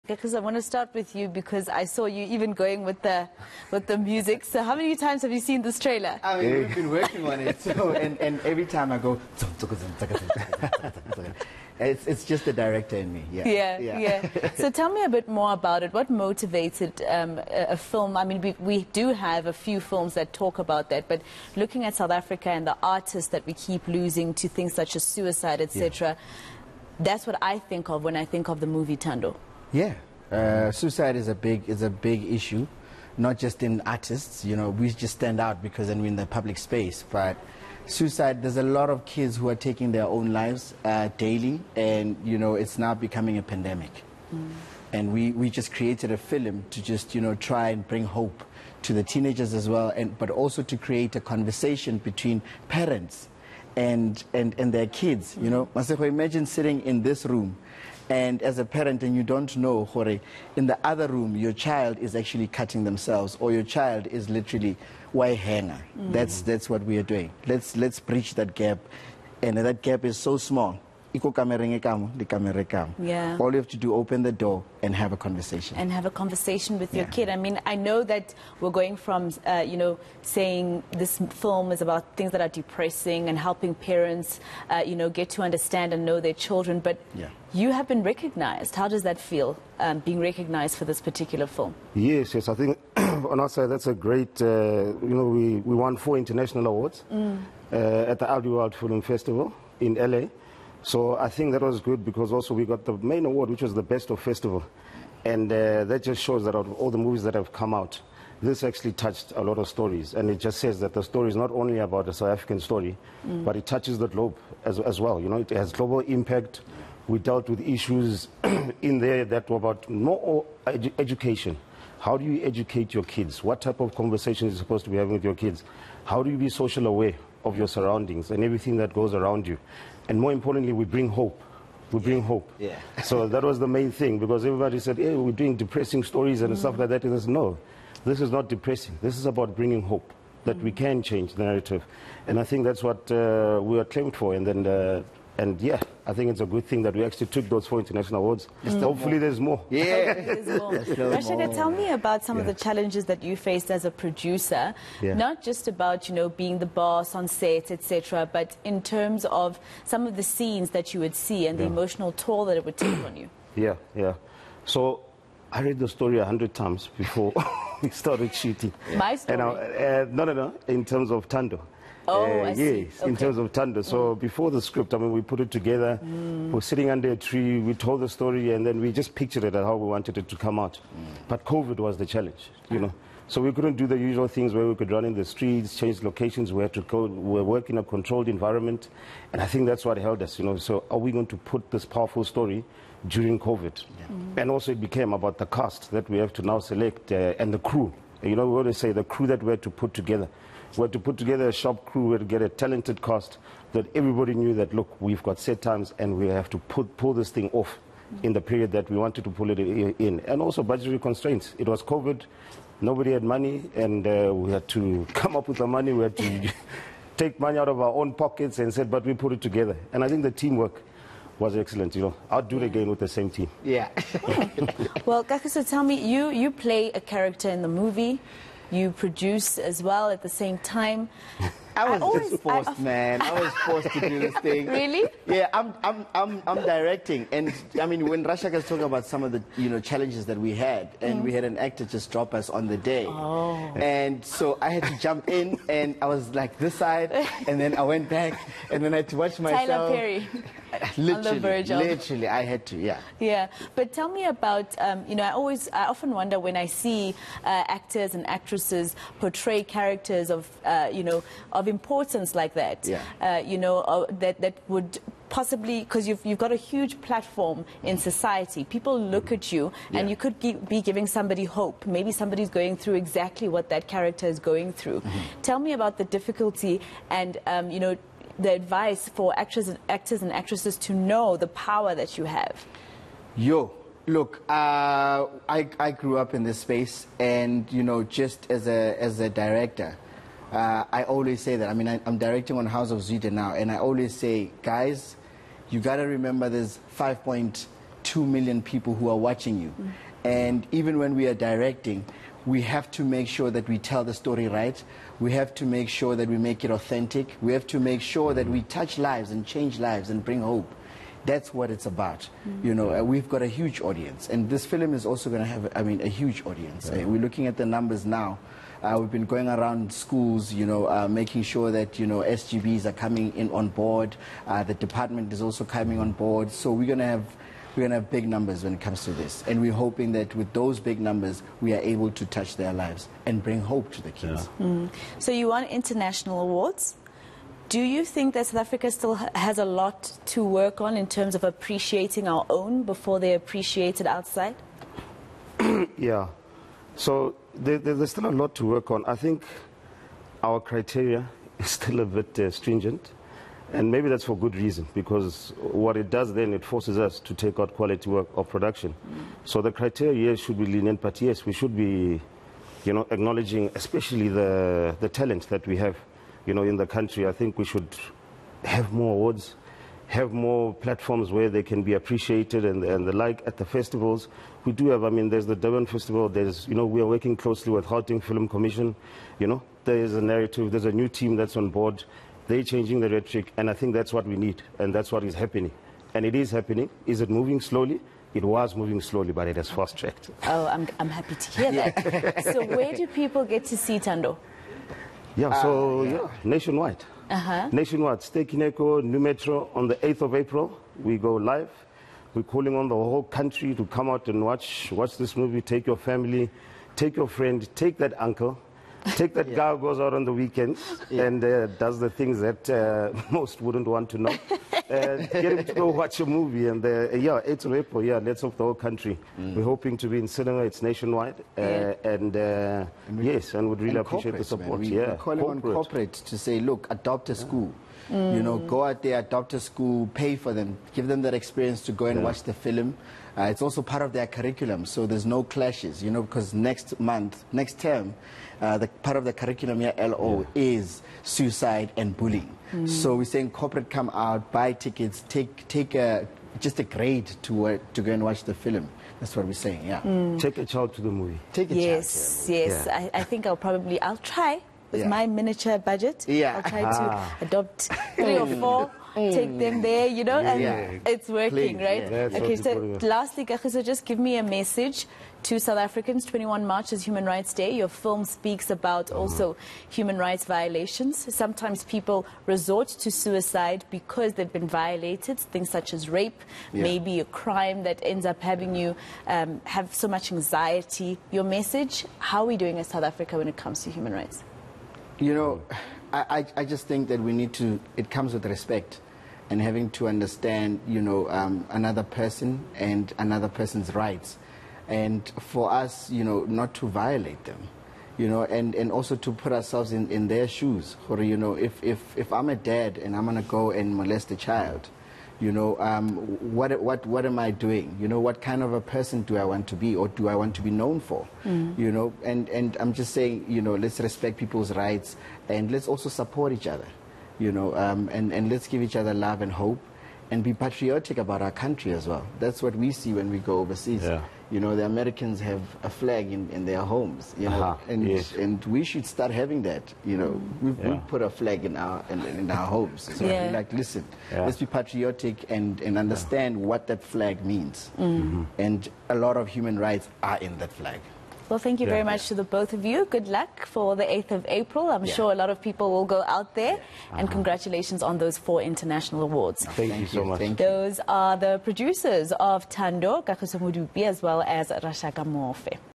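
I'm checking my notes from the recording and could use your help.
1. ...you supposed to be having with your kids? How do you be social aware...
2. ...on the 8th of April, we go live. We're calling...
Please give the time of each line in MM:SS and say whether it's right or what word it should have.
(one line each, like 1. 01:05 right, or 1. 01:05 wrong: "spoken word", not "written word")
1. 02:04 right
2. 06:39 right.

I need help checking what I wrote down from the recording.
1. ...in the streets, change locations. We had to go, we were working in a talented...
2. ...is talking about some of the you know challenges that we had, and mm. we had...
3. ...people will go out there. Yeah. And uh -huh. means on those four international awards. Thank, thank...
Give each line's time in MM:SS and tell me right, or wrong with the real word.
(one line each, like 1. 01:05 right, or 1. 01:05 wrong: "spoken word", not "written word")
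1. 03:05 wrong: "controlled", not "talented"
2. 03:58 right
3. 09:05 wrong: "congratulations", not "means".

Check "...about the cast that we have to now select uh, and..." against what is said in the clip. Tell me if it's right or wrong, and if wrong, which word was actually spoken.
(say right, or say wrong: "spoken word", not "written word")
right.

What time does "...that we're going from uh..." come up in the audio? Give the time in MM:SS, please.
01:18.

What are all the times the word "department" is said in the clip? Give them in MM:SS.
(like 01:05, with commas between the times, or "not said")
05:24.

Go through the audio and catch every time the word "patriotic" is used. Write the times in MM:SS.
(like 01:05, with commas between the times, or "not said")
08:40, 08:54.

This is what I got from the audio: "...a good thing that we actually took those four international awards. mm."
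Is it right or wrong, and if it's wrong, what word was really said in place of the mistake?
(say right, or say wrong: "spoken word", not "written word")
right.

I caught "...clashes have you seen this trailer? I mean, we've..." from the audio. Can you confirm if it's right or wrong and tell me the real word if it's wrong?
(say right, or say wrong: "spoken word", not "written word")
wrong: "times", not "clashes".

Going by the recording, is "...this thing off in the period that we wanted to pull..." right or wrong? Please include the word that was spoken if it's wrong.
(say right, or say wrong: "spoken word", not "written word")
right.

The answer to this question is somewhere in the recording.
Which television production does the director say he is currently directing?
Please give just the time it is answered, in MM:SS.
04:52.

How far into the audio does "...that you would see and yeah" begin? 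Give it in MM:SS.
02:40.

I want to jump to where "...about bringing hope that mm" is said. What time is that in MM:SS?
02:19.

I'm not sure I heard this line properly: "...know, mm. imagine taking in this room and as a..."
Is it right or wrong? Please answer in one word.
wrong.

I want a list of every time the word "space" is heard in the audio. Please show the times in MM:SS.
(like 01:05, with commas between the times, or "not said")
00:36, 04:46.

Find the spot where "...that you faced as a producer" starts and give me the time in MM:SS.
02:33.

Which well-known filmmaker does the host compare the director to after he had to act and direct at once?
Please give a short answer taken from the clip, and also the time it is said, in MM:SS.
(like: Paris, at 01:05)
Tyler Perry, at 04:09.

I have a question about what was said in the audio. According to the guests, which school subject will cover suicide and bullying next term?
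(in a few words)
LO.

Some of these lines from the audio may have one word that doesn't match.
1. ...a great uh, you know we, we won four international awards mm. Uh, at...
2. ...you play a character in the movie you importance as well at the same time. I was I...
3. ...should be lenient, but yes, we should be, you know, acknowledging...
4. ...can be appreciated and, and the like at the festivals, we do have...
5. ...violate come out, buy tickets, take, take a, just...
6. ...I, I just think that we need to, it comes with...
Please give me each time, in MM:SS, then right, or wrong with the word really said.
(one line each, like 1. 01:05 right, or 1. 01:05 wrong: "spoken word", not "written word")
1. 01:33 right
2. 03:46 wrong: "produce", not "importance"
3. 06:00 right
4. 06:11 right
5. 07:23 wrong: "corporate", not "violate"
6. 08:06 right.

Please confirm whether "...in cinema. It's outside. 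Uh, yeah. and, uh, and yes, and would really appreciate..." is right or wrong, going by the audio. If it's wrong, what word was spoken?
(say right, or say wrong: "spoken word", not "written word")
wrong: "nationwide", not "outside".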